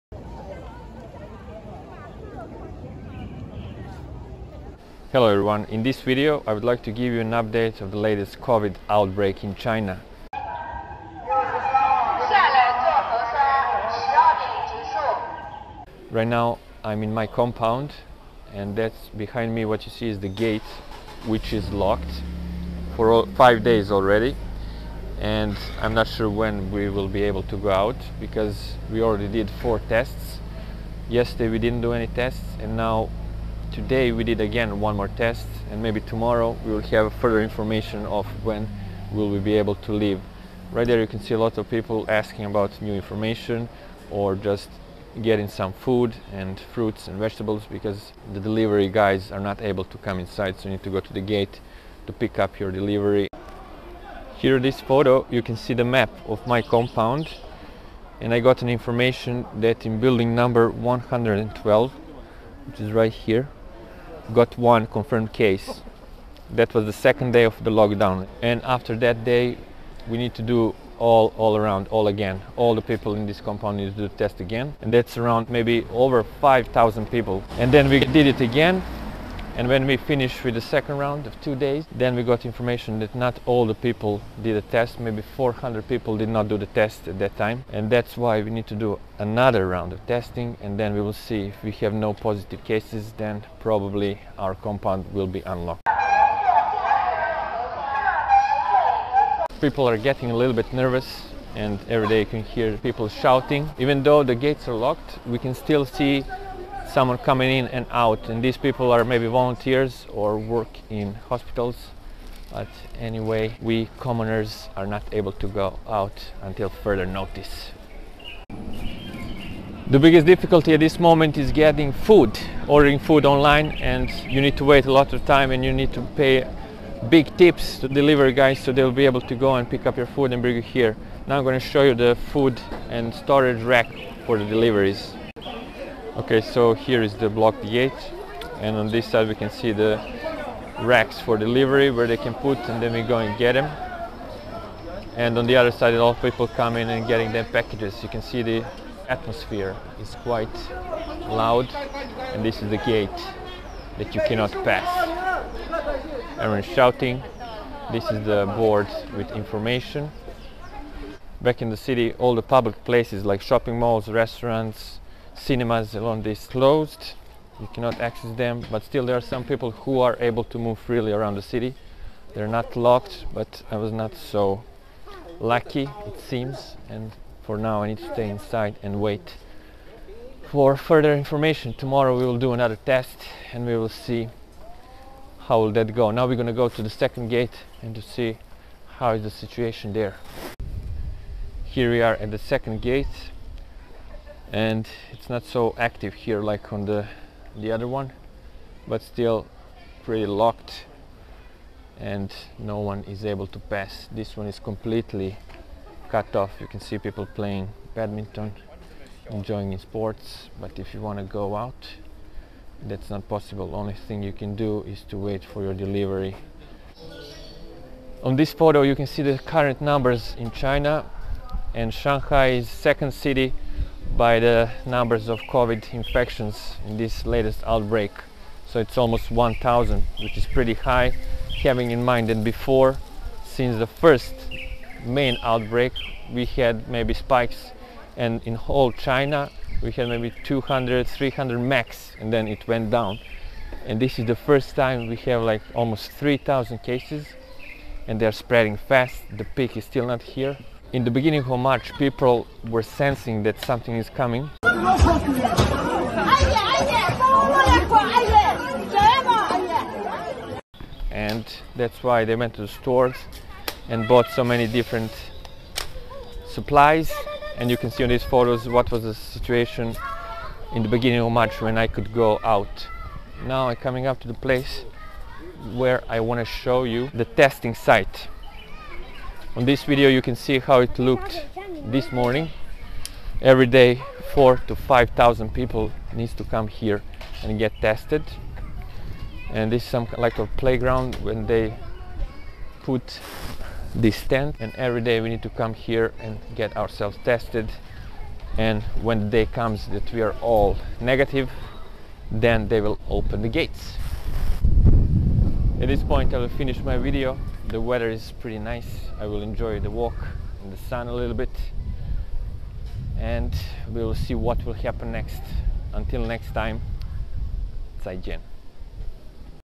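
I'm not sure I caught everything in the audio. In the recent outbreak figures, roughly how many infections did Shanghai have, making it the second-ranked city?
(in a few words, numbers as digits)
1,000.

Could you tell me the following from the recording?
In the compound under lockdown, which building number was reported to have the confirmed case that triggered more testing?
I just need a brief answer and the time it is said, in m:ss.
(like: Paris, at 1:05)
112, at 1:00.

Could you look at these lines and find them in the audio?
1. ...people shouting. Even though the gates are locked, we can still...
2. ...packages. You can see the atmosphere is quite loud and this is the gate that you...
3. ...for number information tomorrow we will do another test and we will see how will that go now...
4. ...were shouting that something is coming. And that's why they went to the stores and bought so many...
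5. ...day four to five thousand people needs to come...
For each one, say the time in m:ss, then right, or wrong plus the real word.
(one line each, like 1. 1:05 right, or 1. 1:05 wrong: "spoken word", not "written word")
1. 1:42 right
2. 2:27 right
3. 3:00 wrong: "further", not "number"
4. 4:12 wrong: "sensing", not "shouting"
5. 4:43 right.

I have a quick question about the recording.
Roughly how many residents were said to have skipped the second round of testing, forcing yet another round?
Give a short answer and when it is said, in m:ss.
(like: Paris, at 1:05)
400, at 1:25.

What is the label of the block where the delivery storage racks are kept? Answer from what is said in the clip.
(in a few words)
D8.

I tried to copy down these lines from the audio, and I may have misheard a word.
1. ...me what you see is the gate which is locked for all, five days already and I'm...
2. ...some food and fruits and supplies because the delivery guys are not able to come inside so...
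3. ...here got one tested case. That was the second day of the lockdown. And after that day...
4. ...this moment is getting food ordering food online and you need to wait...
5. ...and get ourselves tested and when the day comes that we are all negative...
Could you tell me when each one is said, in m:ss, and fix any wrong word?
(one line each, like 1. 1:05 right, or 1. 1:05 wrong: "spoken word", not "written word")
1. 0:19 right
2. 0:45 wrong: "vegetables", not "supplies"
3. 1:03 wrong: "confirmed", not "tested"
4. 2:00 right
5. 4:56 right.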